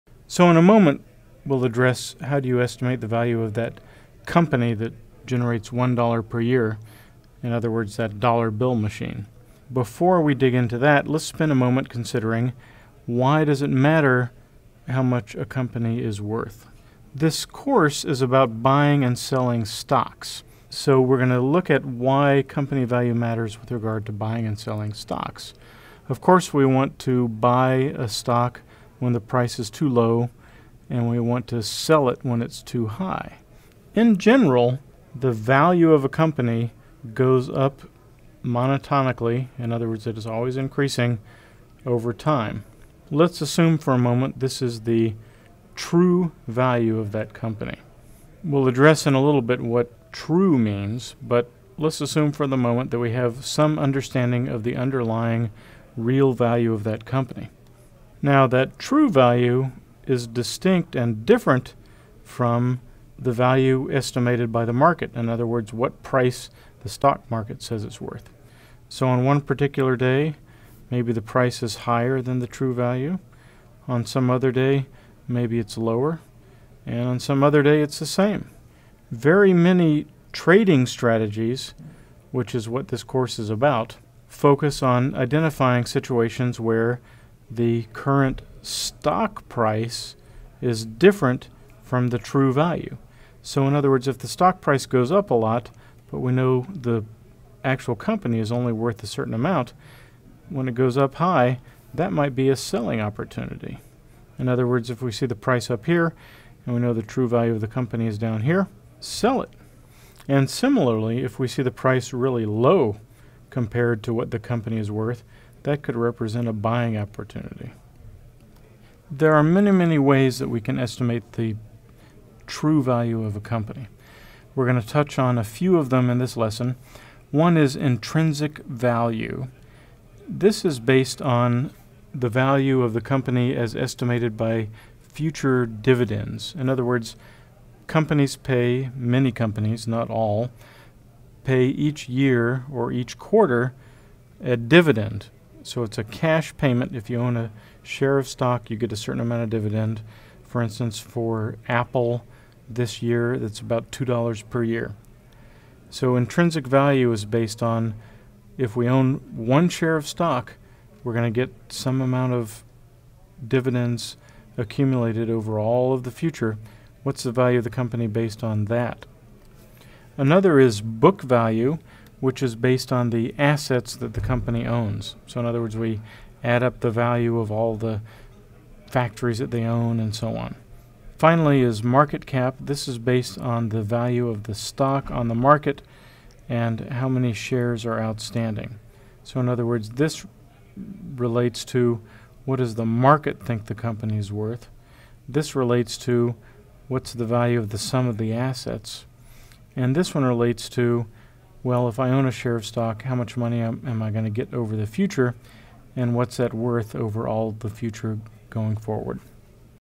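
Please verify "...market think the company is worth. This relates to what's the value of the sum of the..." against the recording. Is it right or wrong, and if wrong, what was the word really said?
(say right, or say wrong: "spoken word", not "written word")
right.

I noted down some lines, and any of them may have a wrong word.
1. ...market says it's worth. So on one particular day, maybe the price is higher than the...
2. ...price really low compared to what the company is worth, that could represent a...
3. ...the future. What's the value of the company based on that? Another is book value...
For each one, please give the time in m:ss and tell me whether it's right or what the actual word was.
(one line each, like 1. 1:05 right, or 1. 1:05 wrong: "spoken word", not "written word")
1. 1:07 right
2. 1:51 right
3. 2:46 right.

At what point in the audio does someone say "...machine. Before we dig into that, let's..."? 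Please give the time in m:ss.
0:08.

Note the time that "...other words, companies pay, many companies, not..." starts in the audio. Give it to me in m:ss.
2:16.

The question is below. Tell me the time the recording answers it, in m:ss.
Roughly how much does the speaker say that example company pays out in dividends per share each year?
2:33.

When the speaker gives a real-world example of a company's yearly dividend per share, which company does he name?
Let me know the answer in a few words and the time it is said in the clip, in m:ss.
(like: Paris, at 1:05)
Apple, at 2:31.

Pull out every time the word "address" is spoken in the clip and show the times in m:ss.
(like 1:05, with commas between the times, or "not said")
0:01, 0:48.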